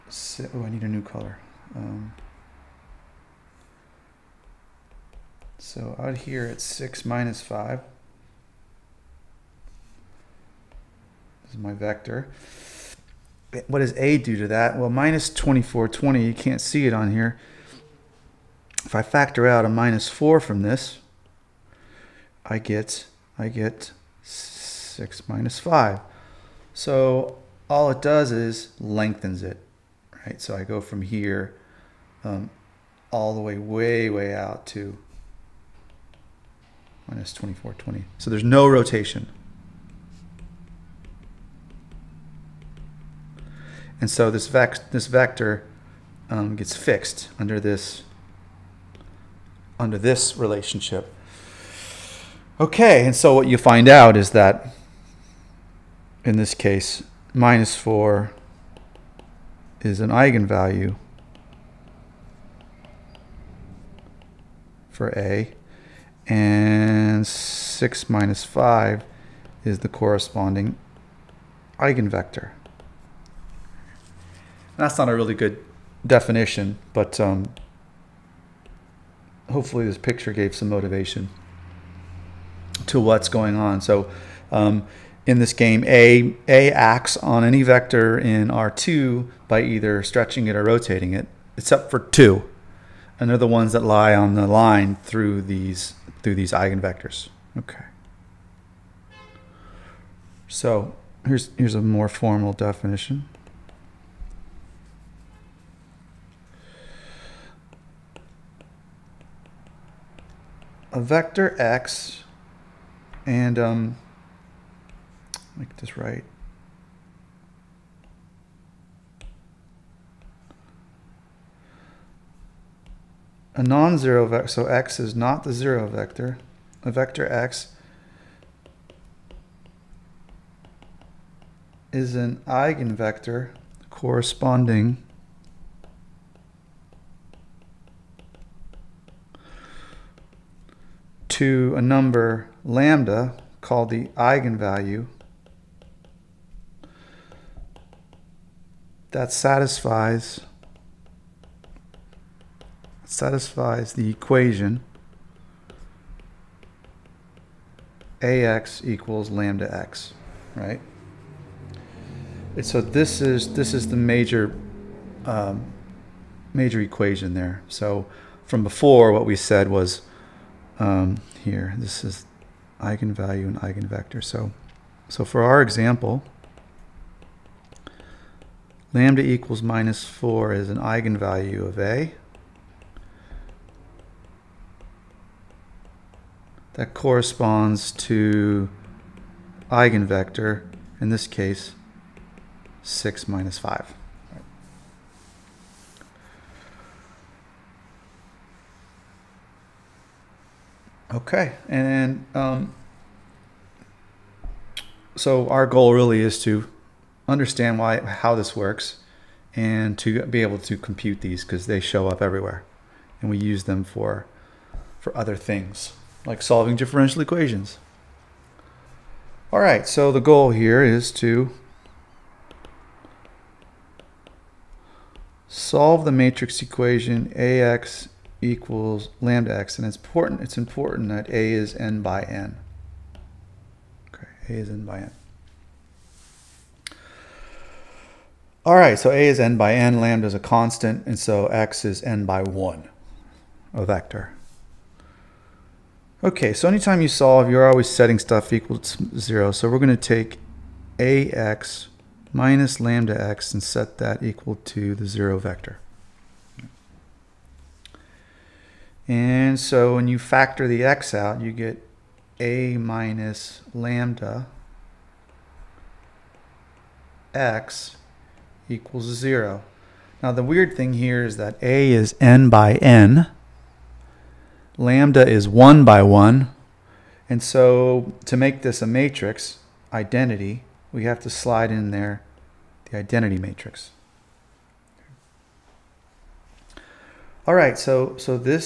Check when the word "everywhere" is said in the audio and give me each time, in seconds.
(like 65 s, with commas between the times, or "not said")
212 s.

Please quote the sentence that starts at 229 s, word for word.
And it's important, it's important that A is n by n.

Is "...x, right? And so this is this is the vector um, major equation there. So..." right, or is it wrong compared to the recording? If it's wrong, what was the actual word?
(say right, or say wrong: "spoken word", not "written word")
wrong: "major", not "vector".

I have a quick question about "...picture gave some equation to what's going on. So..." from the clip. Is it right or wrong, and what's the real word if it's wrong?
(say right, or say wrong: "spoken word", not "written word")
wrong: "motivation", not "equation".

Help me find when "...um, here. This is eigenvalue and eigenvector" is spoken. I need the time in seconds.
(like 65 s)
170 s.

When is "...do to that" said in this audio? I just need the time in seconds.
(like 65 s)
14 s.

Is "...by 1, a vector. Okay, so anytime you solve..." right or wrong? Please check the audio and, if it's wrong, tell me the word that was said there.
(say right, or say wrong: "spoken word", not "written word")
right.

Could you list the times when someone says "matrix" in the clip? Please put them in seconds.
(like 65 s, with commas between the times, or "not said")
226 s, 278 s, 283 s.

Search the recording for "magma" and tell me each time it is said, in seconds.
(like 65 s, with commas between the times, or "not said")
not said.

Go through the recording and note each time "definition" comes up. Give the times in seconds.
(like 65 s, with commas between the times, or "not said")
76 s, 102 s.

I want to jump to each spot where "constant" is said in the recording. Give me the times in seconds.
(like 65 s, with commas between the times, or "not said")
240 s.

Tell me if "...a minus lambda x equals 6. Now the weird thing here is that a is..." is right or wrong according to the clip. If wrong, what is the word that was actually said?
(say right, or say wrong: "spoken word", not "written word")
wrong: "0", not "6".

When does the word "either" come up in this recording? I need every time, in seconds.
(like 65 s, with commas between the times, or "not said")
89 s.